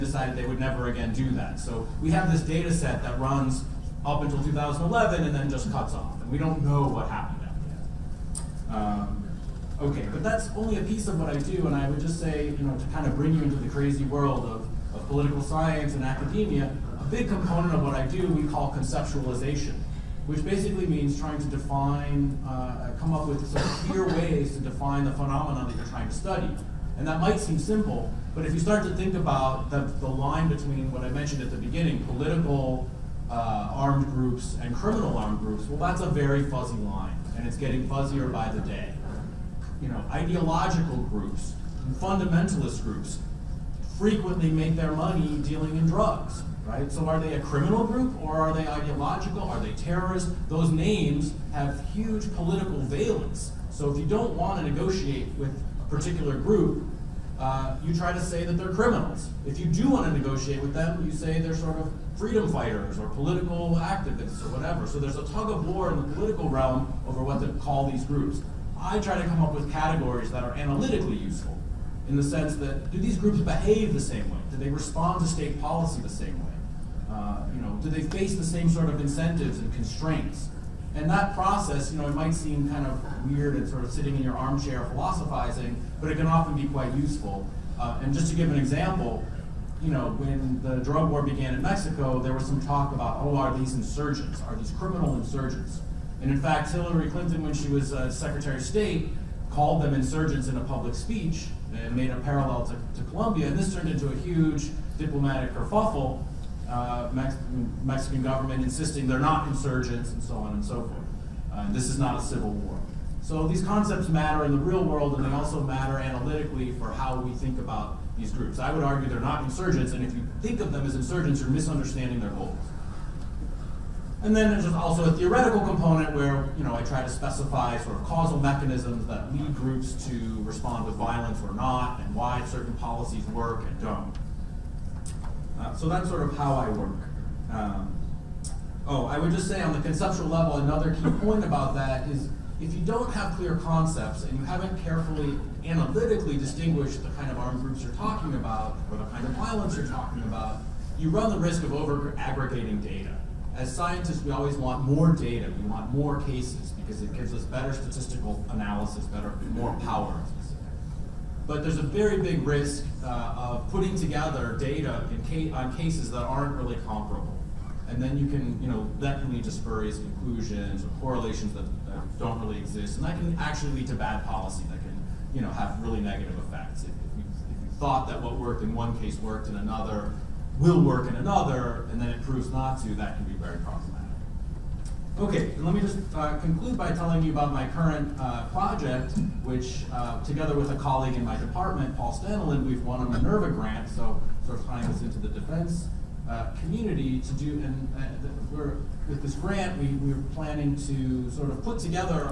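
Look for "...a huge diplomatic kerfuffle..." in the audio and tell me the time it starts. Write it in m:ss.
1:44.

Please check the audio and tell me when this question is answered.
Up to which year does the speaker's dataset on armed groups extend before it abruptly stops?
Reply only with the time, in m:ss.
0:04.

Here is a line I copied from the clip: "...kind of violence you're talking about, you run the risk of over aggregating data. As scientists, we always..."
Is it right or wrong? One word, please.
right.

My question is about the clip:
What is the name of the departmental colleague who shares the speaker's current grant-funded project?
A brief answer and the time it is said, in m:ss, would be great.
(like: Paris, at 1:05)
Paul Staniland, at 3:11.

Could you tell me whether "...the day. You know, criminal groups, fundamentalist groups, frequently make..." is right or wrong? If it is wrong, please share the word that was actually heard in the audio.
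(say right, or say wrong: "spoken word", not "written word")
wrong: "ideological", not "criminal".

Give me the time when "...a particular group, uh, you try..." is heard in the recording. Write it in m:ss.
0:55.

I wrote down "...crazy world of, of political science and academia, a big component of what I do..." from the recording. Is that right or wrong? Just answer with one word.
right.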